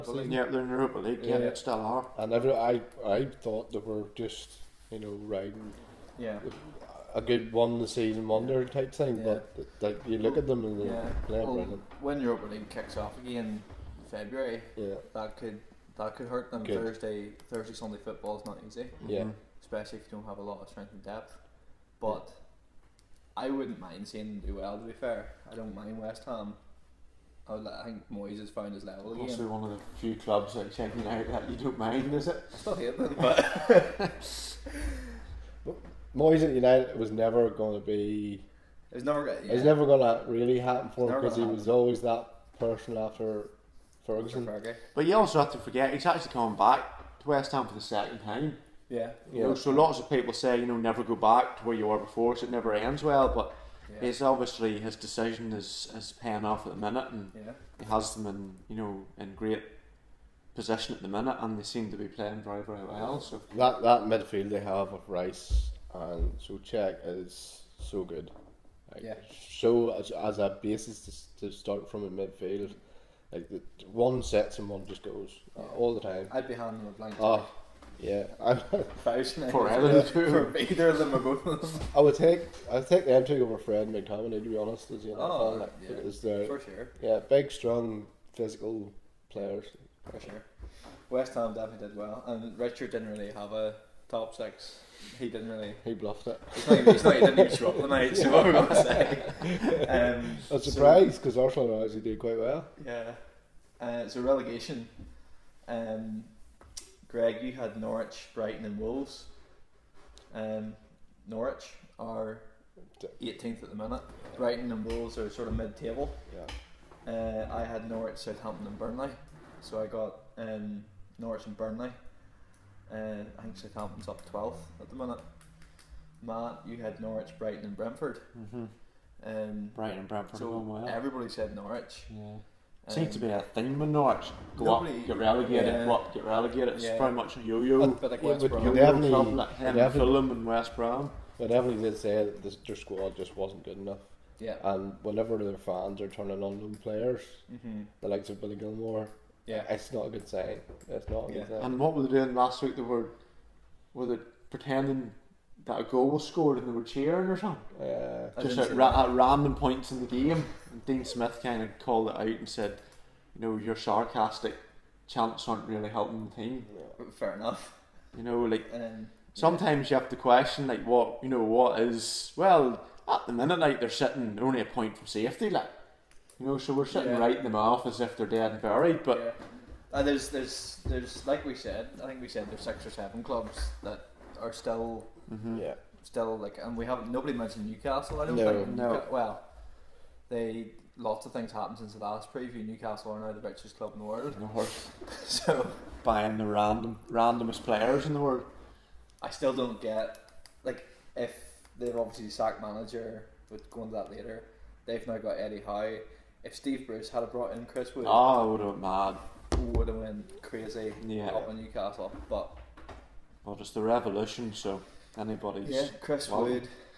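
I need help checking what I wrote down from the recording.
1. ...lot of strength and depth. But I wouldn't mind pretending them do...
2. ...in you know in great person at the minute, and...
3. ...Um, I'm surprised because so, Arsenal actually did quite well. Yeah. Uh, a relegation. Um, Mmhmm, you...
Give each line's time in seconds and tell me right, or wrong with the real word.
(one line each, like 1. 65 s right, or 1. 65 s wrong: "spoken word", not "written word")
1. 20 s wrong: "seeing", not "pretending"
2. 58 s wrong: "position", not "person"
3. 99 s wrong: "Greg", not "Mmhmm".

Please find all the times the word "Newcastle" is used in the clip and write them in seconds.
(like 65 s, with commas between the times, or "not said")
187 s, 192 s, 211 s.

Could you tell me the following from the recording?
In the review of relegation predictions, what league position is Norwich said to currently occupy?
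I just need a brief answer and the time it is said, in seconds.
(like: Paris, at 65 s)
18th, at 113 s.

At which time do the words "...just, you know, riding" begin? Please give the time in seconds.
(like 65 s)
4 s.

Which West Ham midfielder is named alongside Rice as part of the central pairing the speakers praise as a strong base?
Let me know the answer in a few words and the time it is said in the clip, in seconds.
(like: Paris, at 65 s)
Souček, at 66 s.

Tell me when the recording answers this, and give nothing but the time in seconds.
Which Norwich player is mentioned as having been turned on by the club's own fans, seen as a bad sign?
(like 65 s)
148 s.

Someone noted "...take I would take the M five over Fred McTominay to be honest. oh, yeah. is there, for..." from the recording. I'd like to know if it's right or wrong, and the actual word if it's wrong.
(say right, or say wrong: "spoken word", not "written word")
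wrong: "two", not "five".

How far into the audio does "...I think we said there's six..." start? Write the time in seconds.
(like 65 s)
182 s.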